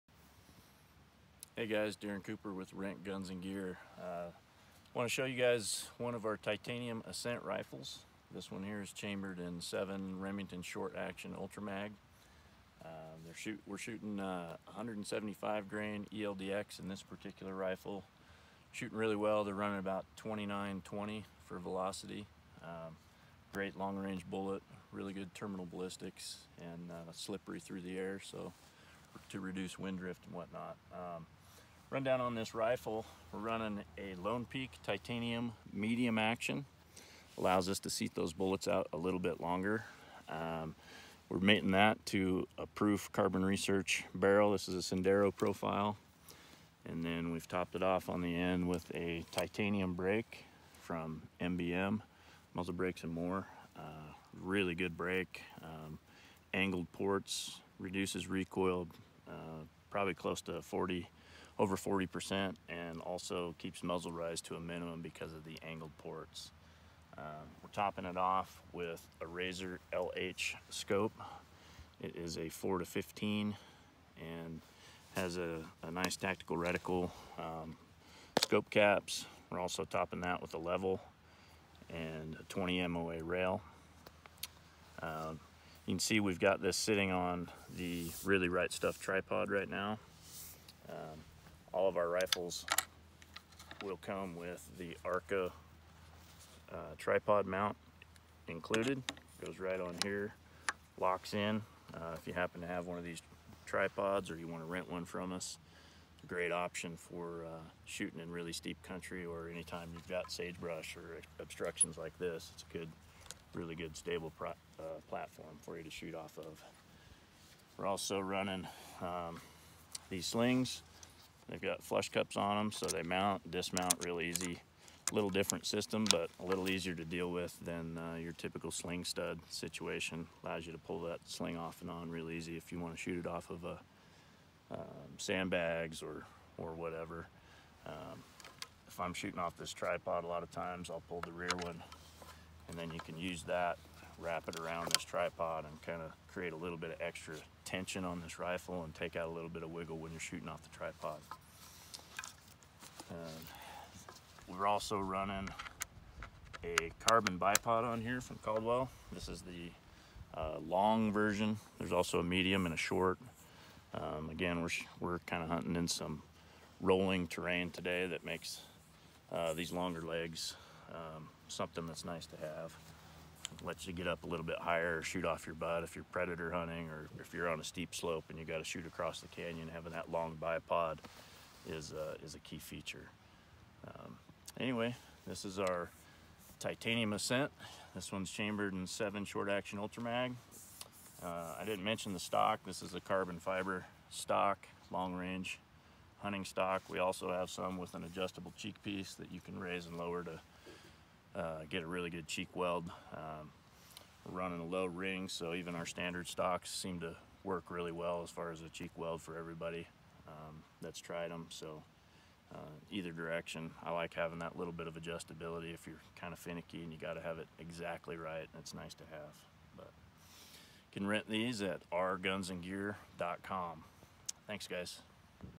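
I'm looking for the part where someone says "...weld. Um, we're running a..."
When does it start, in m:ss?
3:22.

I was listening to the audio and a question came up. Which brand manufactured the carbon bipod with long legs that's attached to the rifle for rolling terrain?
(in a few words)
Caldwell.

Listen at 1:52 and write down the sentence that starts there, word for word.
It's a good, really good stable uh, platform for you to shoot off of.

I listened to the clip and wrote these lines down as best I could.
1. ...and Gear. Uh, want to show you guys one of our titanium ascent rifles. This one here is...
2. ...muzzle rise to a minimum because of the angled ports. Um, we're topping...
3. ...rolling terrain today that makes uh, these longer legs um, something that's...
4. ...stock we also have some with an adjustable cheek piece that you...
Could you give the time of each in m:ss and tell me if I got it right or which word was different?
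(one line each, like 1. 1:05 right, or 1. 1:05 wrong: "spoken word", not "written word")
1. 0:03 right
2. 1:03 right
3. 2:46 right
4. 3:16 right.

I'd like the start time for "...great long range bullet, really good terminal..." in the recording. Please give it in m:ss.
0:23.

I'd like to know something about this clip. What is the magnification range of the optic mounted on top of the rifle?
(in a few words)
4 to 15.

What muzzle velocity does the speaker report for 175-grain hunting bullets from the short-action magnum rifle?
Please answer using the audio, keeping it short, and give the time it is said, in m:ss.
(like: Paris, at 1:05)
2920, at 0:20.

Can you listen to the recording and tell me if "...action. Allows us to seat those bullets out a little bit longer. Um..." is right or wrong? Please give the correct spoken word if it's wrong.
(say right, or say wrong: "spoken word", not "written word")
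right.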